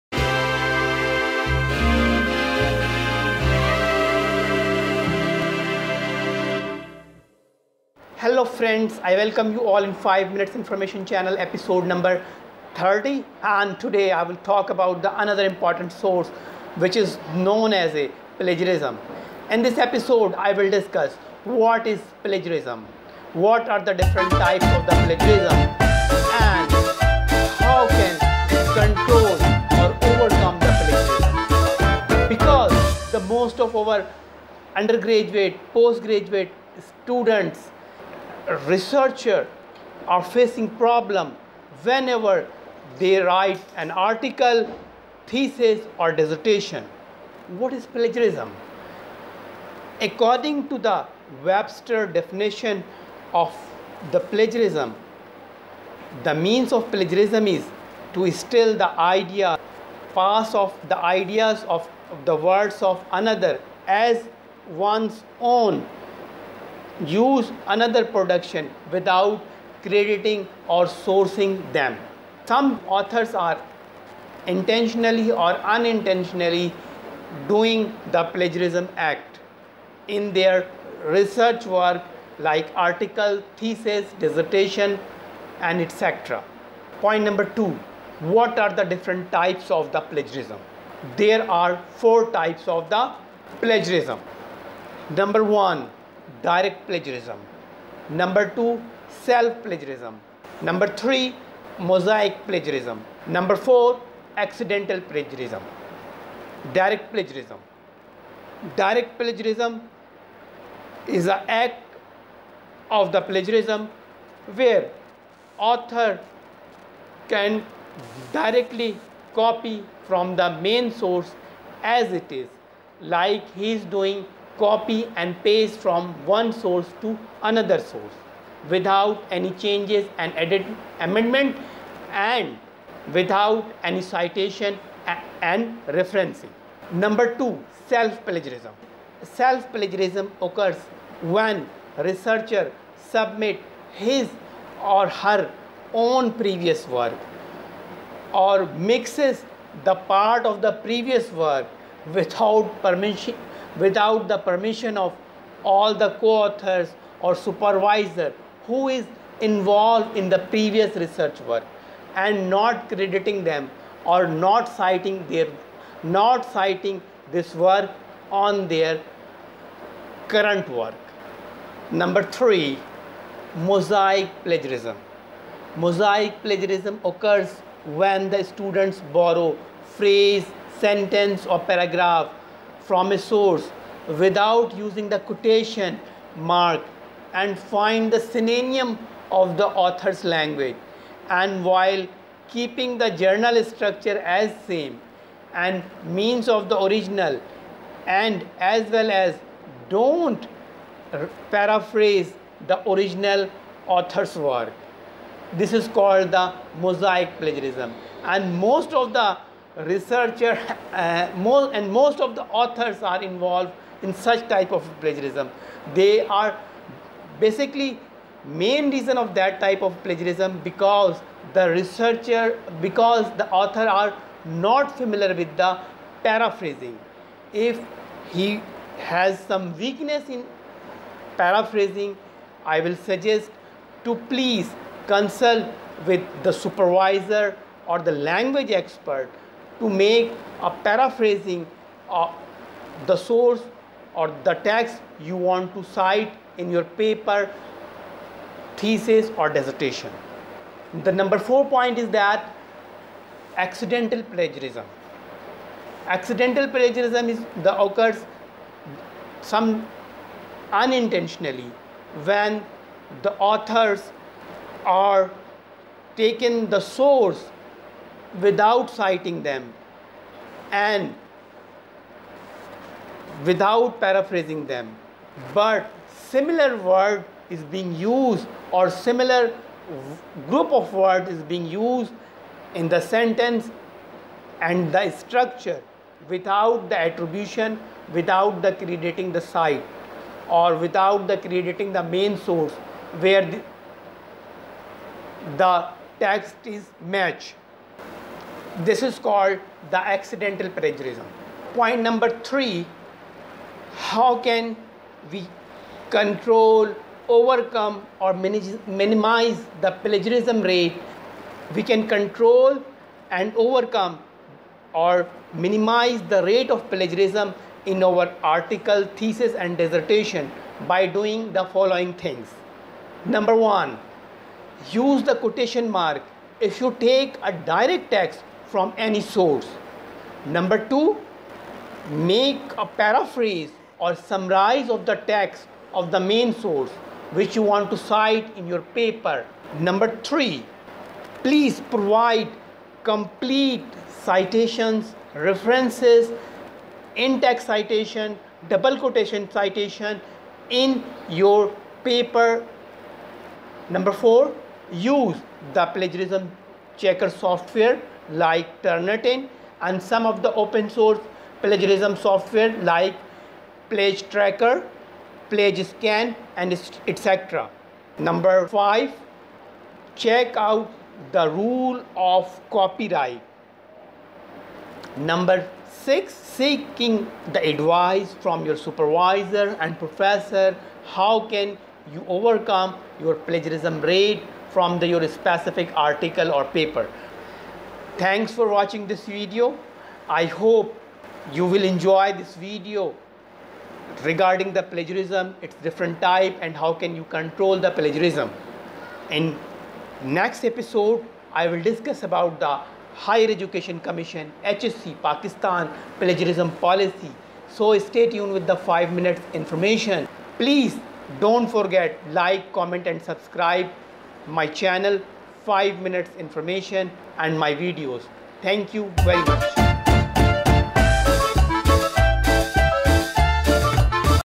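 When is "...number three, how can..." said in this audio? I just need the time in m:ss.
5:02.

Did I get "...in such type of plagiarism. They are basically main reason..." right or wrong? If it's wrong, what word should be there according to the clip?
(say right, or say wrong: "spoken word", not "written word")
right.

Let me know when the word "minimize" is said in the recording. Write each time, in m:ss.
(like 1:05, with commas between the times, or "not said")
5:08, 5:15.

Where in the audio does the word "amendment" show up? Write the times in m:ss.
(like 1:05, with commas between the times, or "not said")
2:10.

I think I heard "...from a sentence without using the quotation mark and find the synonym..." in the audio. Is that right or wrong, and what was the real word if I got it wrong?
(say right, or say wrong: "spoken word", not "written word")
wrong: "source", not "sentence".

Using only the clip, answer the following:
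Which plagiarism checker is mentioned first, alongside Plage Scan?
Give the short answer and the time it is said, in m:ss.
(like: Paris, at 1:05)
PlagTracker, at 6:03.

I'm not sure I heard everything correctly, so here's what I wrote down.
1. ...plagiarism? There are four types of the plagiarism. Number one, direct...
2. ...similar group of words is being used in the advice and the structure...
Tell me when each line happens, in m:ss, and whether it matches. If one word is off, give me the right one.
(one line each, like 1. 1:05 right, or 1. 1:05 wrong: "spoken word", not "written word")
1. 1:30 right
2. 4:38 wrong: "sentence", not "advice".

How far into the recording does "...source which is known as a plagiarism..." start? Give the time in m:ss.
0:16.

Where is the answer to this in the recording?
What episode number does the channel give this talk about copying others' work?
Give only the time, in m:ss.
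0:12.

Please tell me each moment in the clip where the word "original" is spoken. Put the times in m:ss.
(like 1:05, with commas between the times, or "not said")
3:16, 3:22.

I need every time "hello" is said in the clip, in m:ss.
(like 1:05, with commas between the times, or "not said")
0:08.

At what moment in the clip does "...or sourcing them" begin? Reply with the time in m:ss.
1:10.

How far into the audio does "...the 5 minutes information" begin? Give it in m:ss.
6:48.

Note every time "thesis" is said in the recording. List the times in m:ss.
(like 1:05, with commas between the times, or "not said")
0:45, 1:23, 4:08, 5:19.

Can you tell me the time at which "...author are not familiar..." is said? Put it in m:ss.
3:43.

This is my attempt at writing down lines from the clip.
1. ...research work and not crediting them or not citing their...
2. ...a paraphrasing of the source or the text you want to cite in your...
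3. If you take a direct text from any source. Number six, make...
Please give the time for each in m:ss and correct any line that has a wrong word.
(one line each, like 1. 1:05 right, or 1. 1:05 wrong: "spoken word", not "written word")
1. 2:40 right
2. 4:00 right
3. 5:26 wrong: "two", not "six".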